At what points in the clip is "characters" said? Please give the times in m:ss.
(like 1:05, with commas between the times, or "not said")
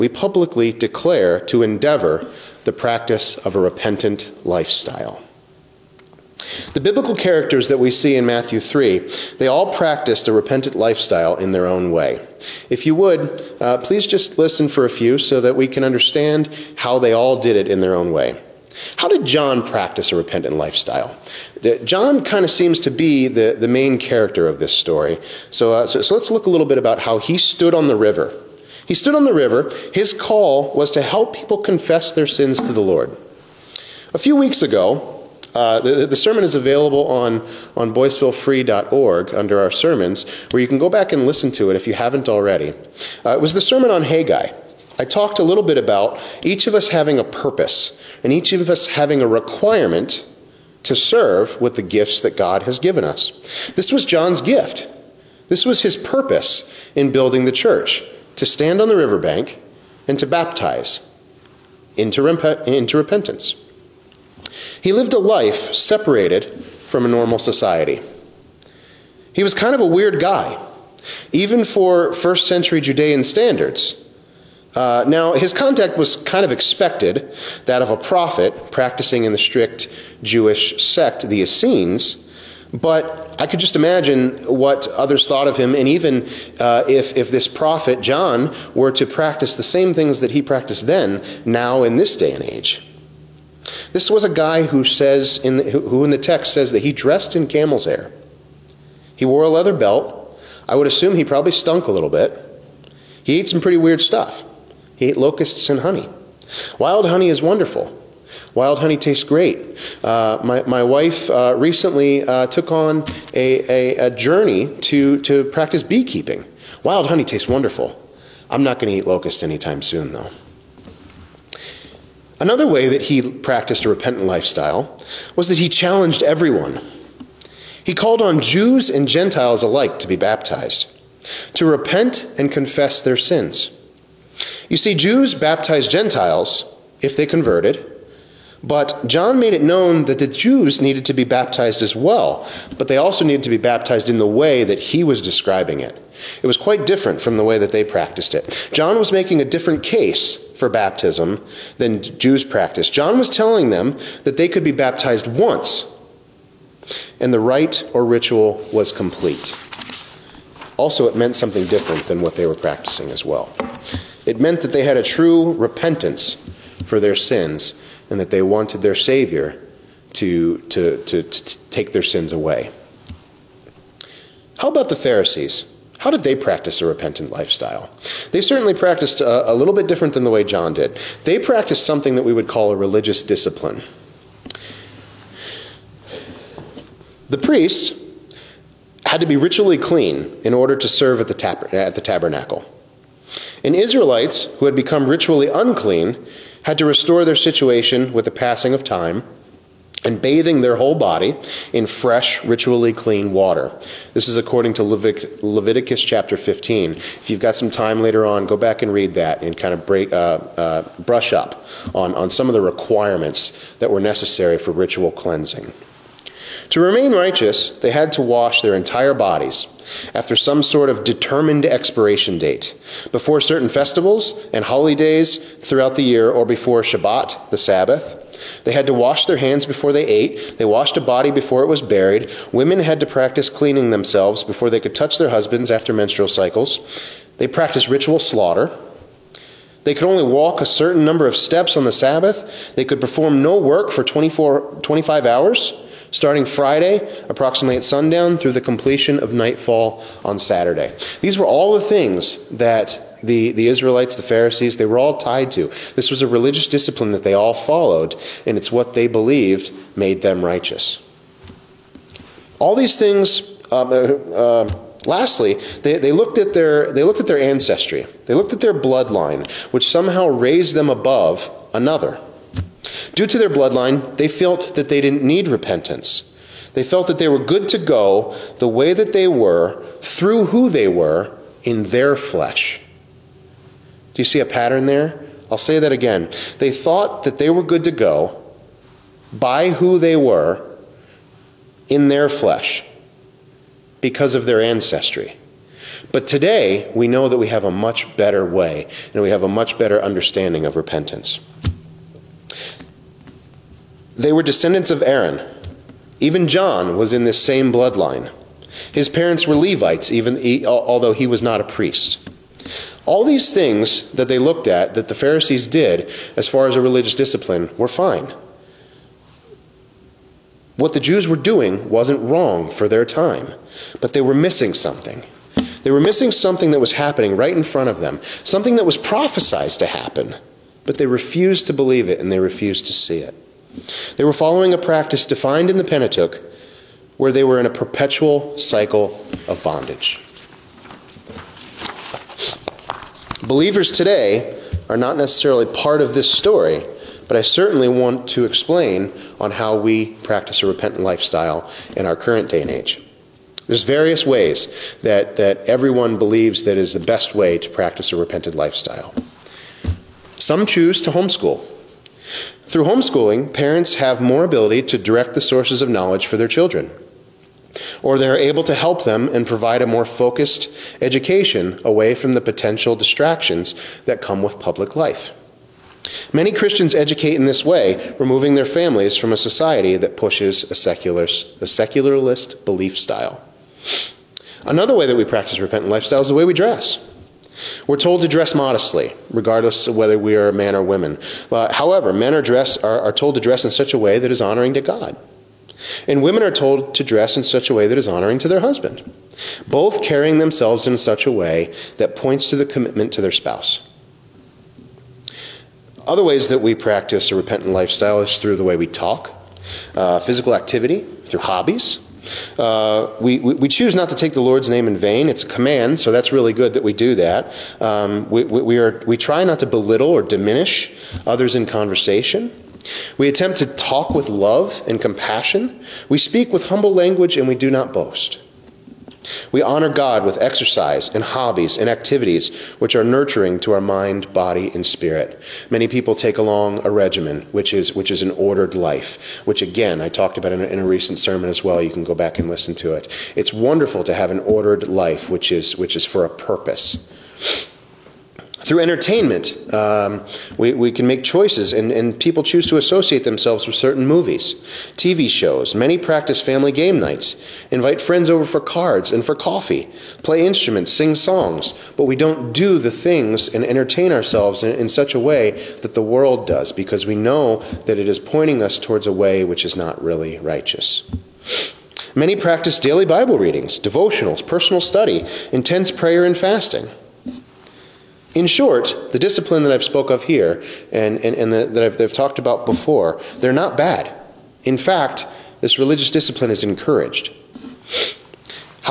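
0:07, 0:23.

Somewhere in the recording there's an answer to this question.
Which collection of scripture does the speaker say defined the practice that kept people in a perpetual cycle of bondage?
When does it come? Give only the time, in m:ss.
5:35.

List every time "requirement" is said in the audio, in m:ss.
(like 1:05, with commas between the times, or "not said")
0:49, 3:32.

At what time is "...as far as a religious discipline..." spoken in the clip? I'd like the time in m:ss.
5:16.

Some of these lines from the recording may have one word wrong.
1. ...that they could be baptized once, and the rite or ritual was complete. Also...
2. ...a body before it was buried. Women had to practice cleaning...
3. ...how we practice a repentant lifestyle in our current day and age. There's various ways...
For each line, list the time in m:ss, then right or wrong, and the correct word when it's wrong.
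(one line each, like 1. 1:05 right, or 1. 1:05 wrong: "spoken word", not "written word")
1. 2:34 right
2. 3:50 right
3. 5:49 right.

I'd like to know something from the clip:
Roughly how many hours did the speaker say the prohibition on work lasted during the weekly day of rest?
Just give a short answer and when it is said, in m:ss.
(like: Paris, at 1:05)
24 to 25 hours, at 4:04.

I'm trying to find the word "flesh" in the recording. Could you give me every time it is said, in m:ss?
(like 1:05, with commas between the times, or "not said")
4:42, 4:52.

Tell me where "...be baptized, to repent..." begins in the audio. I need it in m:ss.
2:10.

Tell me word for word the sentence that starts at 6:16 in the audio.
Many Christians educate in this way, removing their families from a society that pushes a, secular, a secularist belief style.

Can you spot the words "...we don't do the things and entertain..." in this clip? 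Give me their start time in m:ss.
7:42.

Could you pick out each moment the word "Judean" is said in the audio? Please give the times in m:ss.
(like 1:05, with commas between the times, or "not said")
1:12.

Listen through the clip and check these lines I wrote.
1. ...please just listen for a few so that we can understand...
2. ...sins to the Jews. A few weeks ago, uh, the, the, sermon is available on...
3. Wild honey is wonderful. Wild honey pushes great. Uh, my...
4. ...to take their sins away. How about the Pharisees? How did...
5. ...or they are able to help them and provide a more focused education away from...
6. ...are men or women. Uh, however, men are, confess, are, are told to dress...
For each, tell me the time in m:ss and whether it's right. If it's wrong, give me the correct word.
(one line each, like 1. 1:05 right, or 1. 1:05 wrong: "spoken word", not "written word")
1. 0:13 right
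2. 0:32 wrong: "Lord", not "Jews"
3. 1:46 wrong: "tastes", not "pushes"
4. 2:51 right
5. 6:08 right
6. 6:30 wrong: "dress", not "confess".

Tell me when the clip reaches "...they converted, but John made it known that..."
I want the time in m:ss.
2:17.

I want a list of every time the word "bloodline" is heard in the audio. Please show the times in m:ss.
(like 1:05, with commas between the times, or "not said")
4:28, 4:33, 5:07.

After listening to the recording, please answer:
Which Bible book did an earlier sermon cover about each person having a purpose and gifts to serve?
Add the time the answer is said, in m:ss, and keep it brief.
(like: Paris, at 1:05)
Haggai, at 0:44.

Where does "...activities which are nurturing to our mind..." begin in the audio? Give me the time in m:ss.
7:11.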